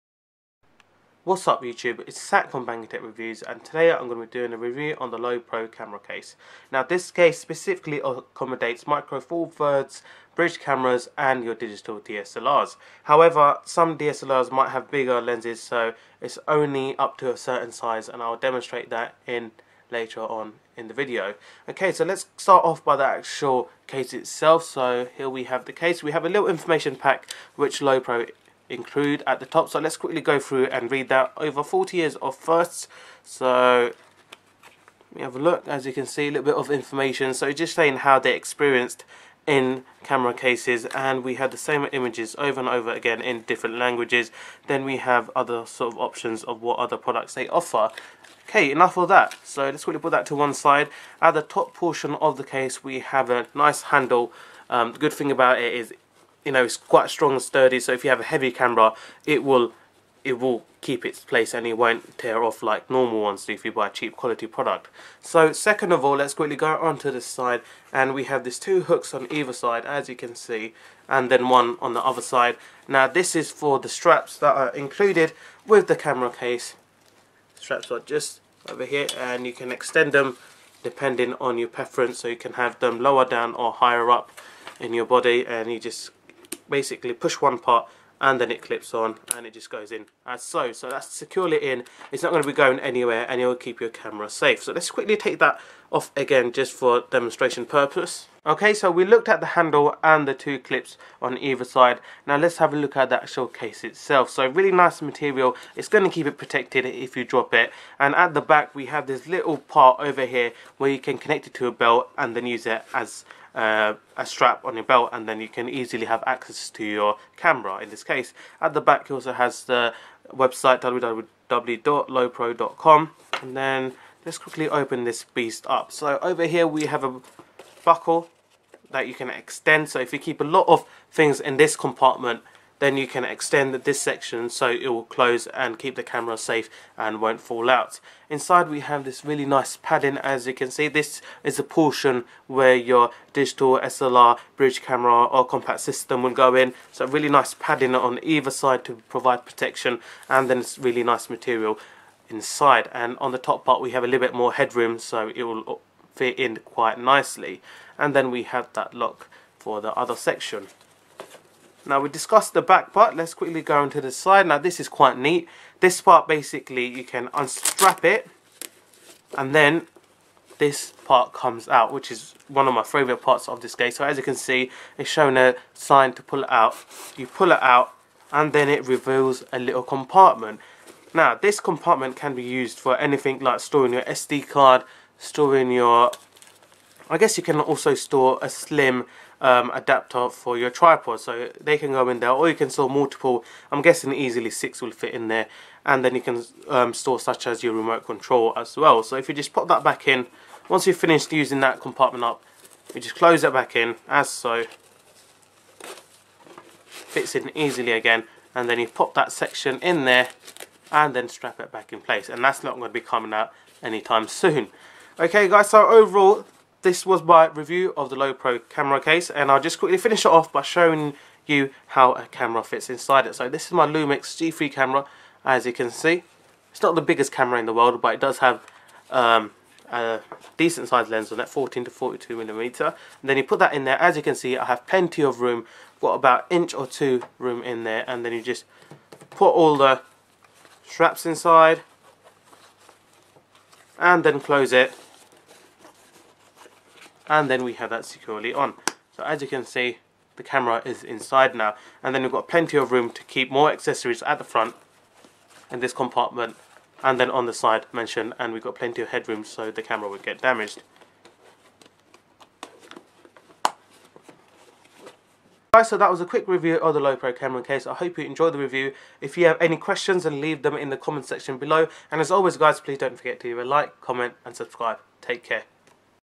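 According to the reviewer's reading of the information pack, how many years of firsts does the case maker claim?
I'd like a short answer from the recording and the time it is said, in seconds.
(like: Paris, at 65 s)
Over 40 years, at 31 s.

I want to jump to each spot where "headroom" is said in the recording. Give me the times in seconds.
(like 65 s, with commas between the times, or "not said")
154 s, 259 s.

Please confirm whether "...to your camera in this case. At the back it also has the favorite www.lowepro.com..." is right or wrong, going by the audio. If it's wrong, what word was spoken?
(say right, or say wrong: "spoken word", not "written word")
wrong: "website", not "favorite".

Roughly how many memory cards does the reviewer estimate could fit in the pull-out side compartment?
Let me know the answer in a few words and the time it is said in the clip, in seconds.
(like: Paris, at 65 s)
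6, at 194 s.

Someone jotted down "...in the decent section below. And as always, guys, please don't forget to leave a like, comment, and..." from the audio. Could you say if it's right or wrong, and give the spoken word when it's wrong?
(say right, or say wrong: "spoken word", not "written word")
wrong: "comment", not "decent".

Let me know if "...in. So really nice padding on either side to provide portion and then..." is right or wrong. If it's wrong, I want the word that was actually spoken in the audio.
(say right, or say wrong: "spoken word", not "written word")
wrong: "protection", not "portion".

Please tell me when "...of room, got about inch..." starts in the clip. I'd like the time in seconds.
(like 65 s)
235 s.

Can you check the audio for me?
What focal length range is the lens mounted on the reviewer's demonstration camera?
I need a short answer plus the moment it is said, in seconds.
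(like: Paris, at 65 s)
14 to 42 millimeter, at 231 s.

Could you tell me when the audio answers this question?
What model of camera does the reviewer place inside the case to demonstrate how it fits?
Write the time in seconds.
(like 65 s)
223 s.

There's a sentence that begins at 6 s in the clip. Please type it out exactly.
Now this case specifically accommodates micro four thirds, bridge cameras and your digital DSLRs.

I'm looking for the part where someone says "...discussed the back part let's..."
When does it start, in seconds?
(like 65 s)
162 s.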